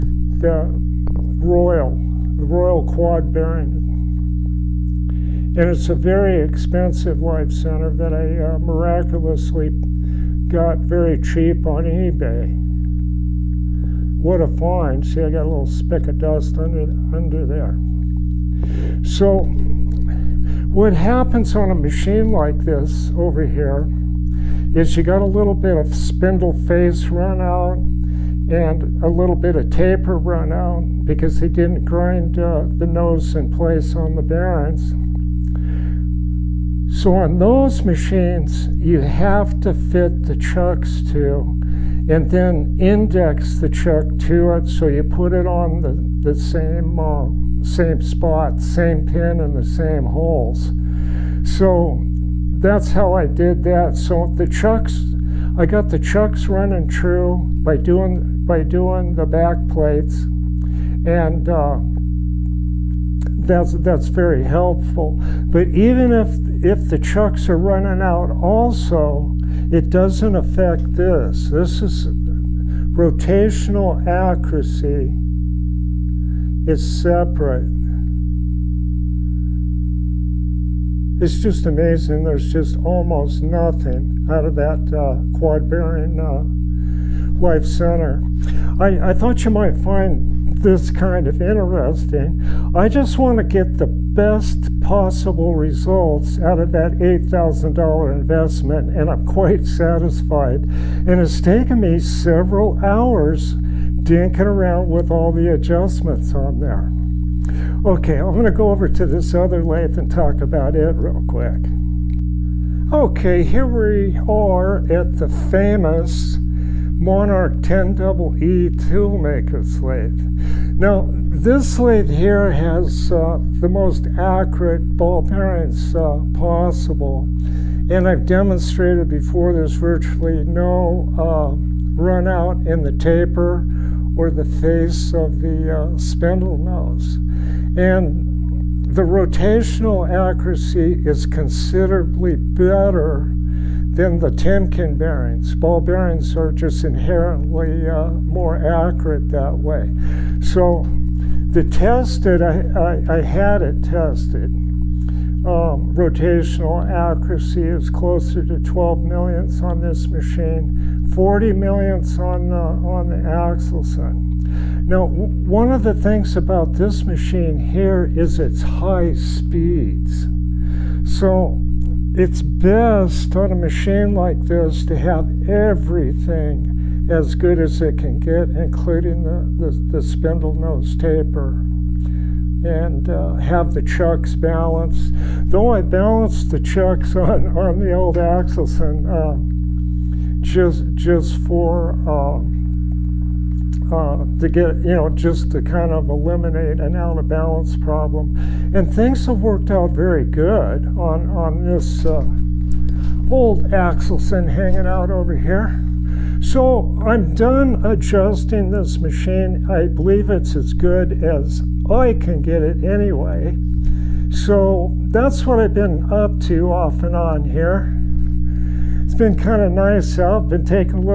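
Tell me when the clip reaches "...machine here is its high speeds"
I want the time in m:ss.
2:47.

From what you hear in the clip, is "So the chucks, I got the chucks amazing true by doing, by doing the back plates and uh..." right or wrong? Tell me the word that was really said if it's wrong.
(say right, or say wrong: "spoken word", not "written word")
wrong: "running", not "amazing".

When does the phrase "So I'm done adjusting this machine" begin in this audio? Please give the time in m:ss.
3:26.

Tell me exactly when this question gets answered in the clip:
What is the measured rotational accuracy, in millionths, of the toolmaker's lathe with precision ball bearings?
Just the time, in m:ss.
2:38.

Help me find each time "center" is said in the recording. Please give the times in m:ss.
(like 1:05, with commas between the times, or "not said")
0:07, 1:27.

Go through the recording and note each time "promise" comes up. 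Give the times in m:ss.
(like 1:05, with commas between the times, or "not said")
not said.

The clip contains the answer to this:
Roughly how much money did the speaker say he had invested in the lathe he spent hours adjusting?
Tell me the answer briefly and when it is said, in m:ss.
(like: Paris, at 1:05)
$8,000, at 1:36.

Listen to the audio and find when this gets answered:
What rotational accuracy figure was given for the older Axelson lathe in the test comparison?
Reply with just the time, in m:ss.
2:41.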